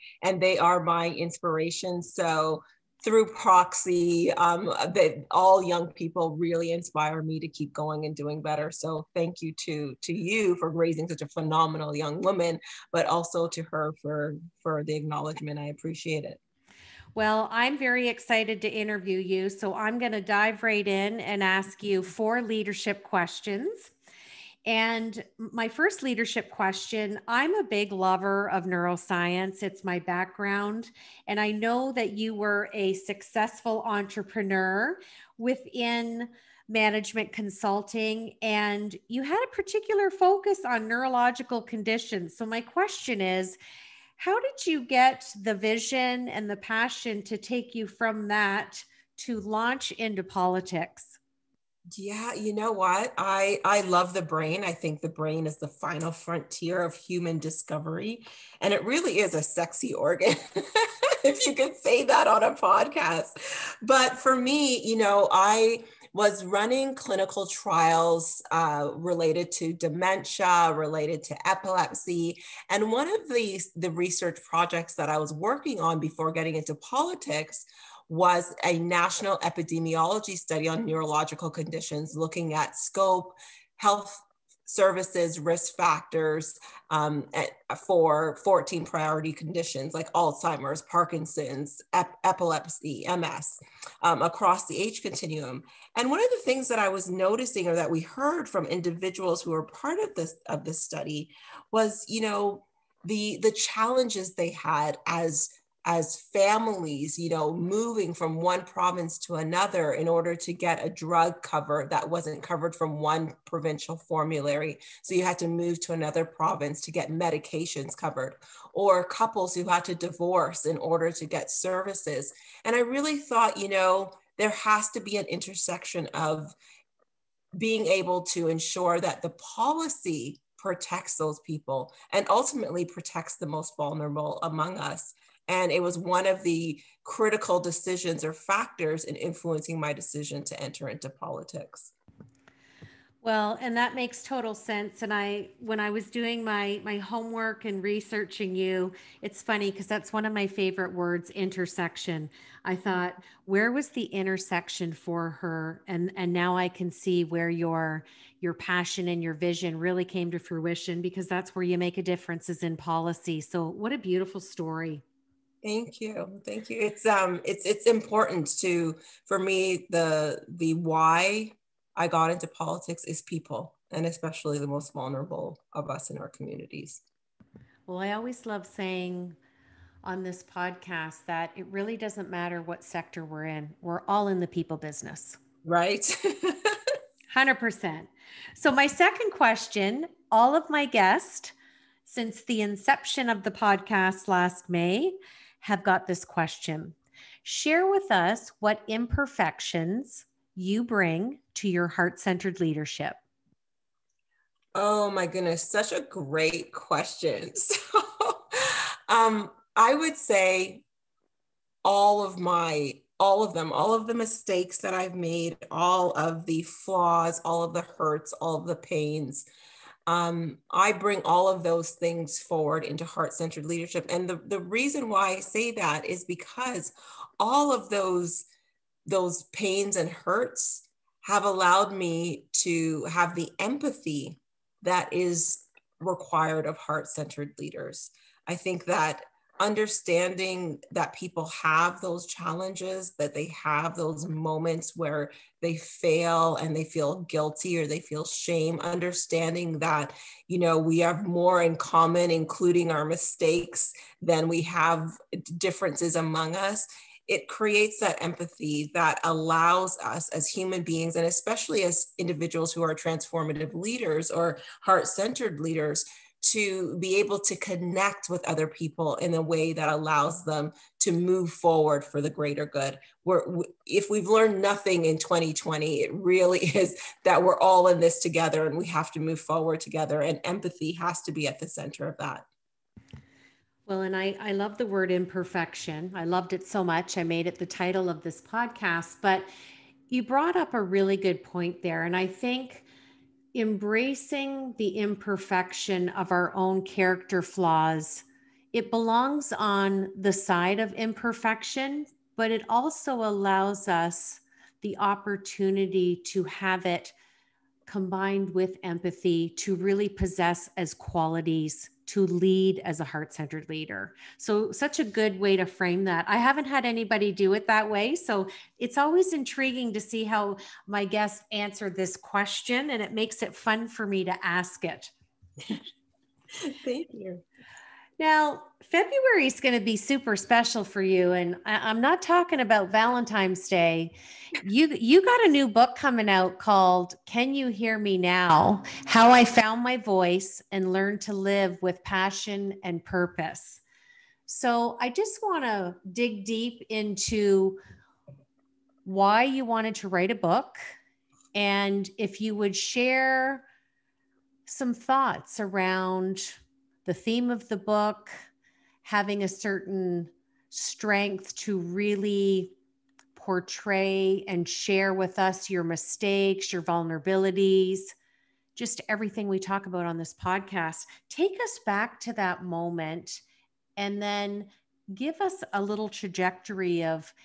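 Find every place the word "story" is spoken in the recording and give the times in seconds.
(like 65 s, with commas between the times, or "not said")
164 s.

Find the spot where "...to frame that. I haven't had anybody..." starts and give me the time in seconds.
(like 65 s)
315 s.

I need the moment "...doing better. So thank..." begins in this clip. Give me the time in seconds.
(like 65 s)
8 s.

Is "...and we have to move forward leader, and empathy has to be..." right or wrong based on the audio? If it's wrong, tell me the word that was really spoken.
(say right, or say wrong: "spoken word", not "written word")
wrong: "together", not "leader".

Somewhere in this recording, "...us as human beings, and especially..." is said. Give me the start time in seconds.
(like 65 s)
260 s.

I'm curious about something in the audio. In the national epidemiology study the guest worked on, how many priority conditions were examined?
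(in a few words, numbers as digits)
14.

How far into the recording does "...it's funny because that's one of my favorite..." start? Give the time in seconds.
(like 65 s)
149 s.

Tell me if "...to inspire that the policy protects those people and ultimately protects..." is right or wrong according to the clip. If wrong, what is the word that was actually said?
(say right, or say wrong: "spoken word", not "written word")
wrong: "ensure", not "inspire".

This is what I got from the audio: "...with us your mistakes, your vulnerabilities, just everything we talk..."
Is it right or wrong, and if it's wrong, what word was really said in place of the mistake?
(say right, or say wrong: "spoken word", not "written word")
right.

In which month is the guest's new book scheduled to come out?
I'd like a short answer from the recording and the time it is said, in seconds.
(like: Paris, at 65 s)
February, at 328 s.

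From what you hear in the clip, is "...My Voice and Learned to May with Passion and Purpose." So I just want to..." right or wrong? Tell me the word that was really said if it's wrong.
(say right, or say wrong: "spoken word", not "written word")
wrong: "Live", not "May".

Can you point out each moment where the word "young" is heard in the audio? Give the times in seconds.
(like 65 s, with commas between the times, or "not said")
5 s, 11 s.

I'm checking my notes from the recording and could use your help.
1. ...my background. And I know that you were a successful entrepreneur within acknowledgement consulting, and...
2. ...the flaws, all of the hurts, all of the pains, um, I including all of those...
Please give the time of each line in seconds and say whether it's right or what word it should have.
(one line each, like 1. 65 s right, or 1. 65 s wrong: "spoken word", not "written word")
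1. 29 s wrong: "management", not "acknowledgement"
2. 216 s wrong: "bring", not "including".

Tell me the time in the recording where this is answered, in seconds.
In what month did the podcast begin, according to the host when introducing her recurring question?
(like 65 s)
194 s.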